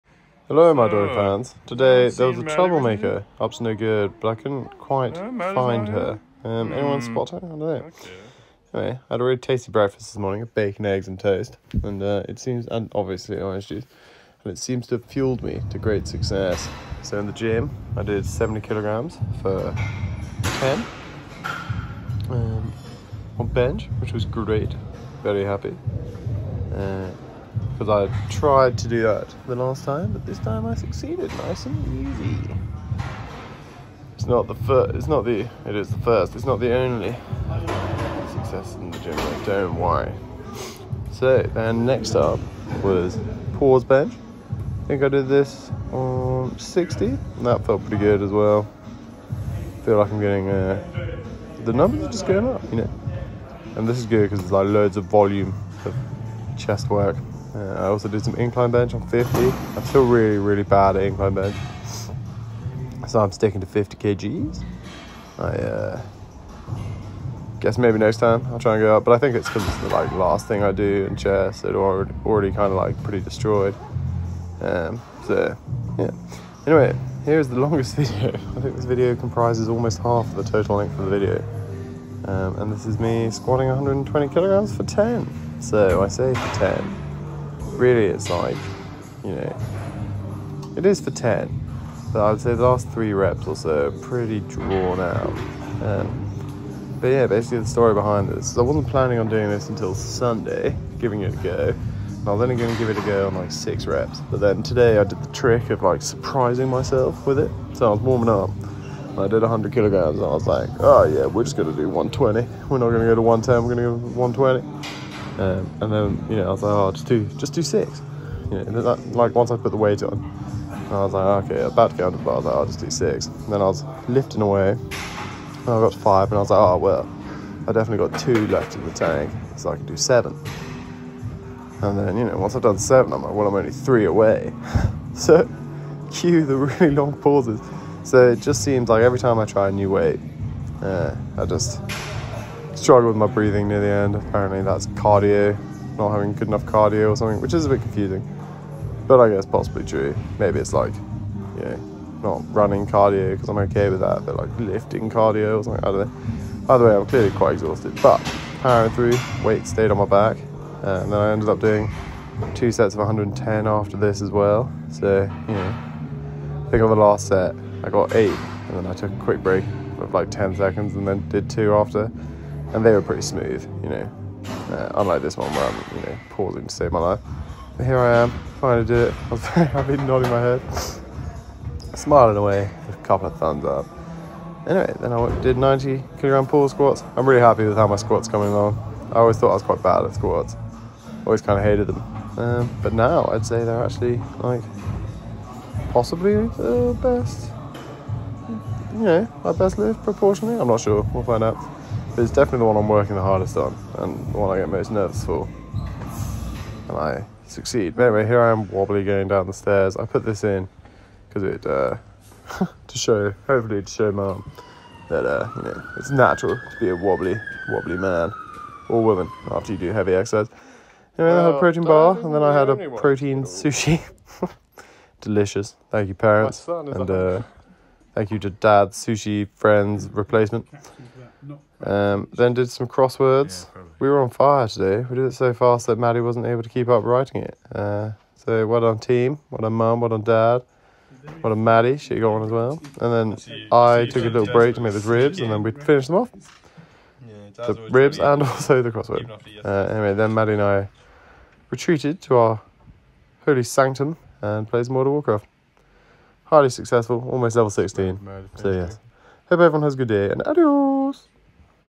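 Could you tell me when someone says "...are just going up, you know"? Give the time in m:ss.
0:52.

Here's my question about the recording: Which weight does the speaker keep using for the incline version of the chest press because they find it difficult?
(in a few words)
50 kgs.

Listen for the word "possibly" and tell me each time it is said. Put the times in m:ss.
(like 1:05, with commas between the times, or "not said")
2:29, 3:15.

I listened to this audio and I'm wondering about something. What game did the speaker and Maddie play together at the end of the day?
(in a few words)
Mortal Warcraft.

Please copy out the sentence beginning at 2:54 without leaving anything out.
Uh, unlike this one where I'm, you know, pausing to save my life.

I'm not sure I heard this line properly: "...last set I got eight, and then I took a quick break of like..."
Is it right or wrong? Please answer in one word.
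right.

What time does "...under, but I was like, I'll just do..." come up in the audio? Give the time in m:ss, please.
2:02.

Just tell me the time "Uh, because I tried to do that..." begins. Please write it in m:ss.
0:26.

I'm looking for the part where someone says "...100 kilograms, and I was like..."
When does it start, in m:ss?
1:49.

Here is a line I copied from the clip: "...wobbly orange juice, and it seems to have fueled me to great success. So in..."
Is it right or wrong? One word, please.
wrong.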